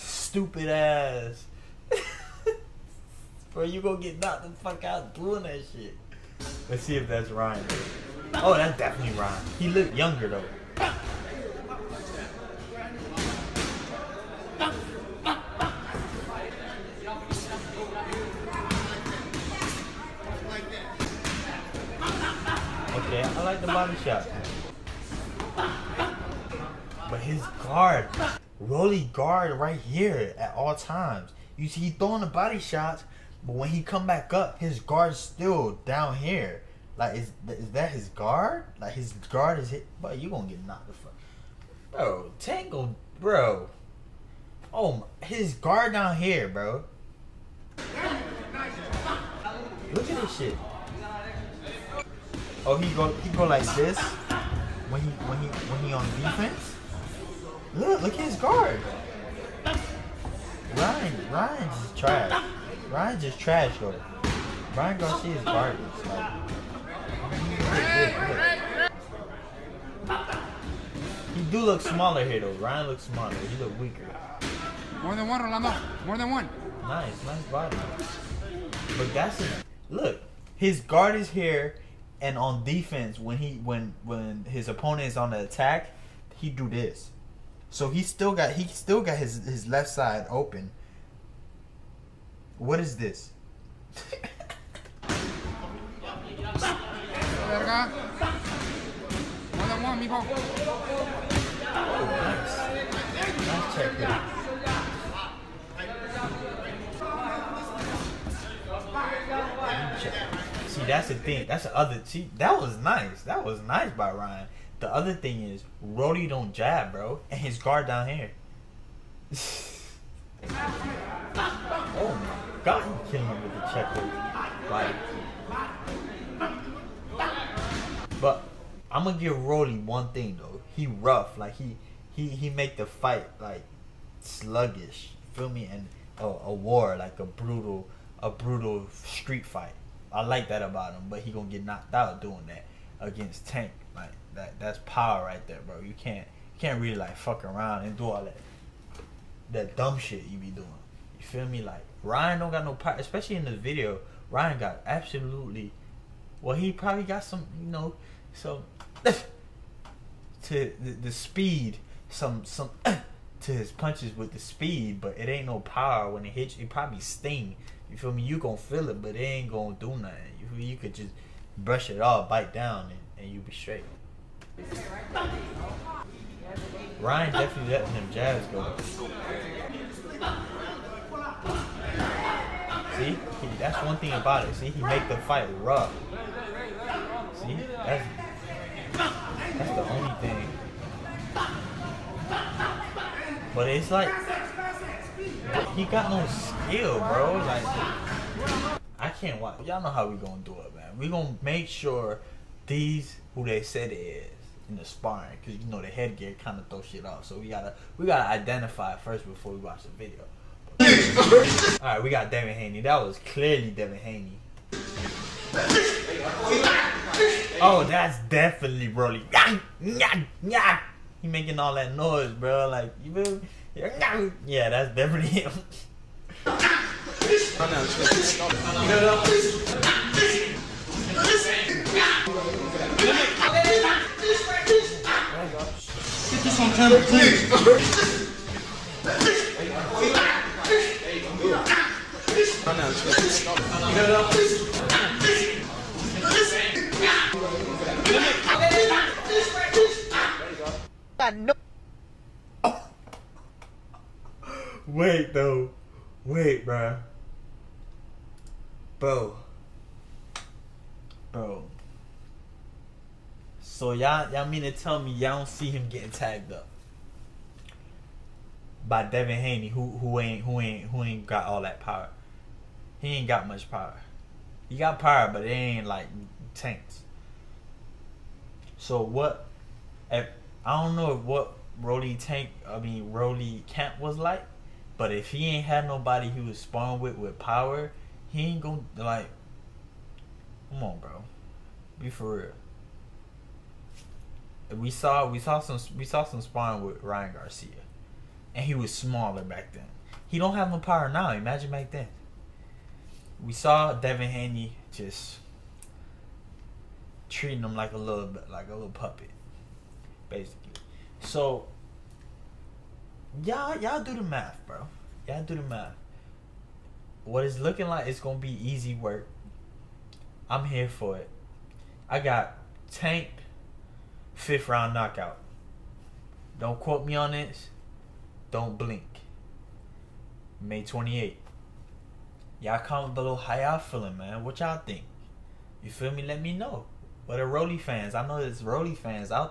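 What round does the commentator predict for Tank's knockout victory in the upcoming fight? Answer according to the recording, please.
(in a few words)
Fifth round.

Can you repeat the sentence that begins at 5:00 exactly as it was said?
He don't have no power now.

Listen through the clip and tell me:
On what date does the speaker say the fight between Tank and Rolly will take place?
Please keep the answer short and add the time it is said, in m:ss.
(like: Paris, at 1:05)
May 28th, at 5:30.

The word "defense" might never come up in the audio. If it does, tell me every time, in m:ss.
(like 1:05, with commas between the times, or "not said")
0:56, 1:22.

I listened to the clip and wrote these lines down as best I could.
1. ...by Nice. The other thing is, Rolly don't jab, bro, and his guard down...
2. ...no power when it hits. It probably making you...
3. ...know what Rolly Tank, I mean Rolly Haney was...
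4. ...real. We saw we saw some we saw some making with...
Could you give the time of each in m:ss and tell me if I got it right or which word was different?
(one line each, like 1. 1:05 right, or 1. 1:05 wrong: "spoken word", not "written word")
1. 1:53 wrong: "Ryan", not "Nice"
2. 2:45 wrong: "sting", not "making"
3. 4:40 wrong: "Camp", not "Haney"
4. 4:54 wrong: "sparring", not "making".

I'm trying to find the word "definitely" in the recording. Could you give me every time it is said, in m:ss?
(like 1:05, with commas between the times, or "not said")
0:08, 2:57, 3:38, 3:44.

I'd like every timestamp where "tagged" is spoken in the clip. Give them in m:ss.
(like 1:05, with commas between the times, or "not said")
4:26.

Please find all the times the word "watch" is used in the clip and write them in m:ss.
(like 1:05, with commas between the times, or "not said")
3:19, 3:29.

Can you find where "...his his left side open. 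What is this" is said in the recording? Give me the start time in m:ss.
1:29.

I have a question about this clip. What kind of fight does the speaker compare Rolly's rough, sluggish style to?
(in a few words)
A brutal street fight.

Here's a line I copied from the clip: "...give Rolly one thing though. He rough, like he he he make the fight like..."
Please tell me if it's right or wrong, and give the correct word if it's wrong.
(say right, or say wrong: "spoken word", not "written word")
right.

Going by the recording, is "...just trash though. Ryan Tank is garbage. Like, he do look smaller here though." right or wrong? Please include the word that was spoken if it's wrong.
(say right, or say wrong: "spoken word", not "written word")
wrong: "Garcia", not "Tank".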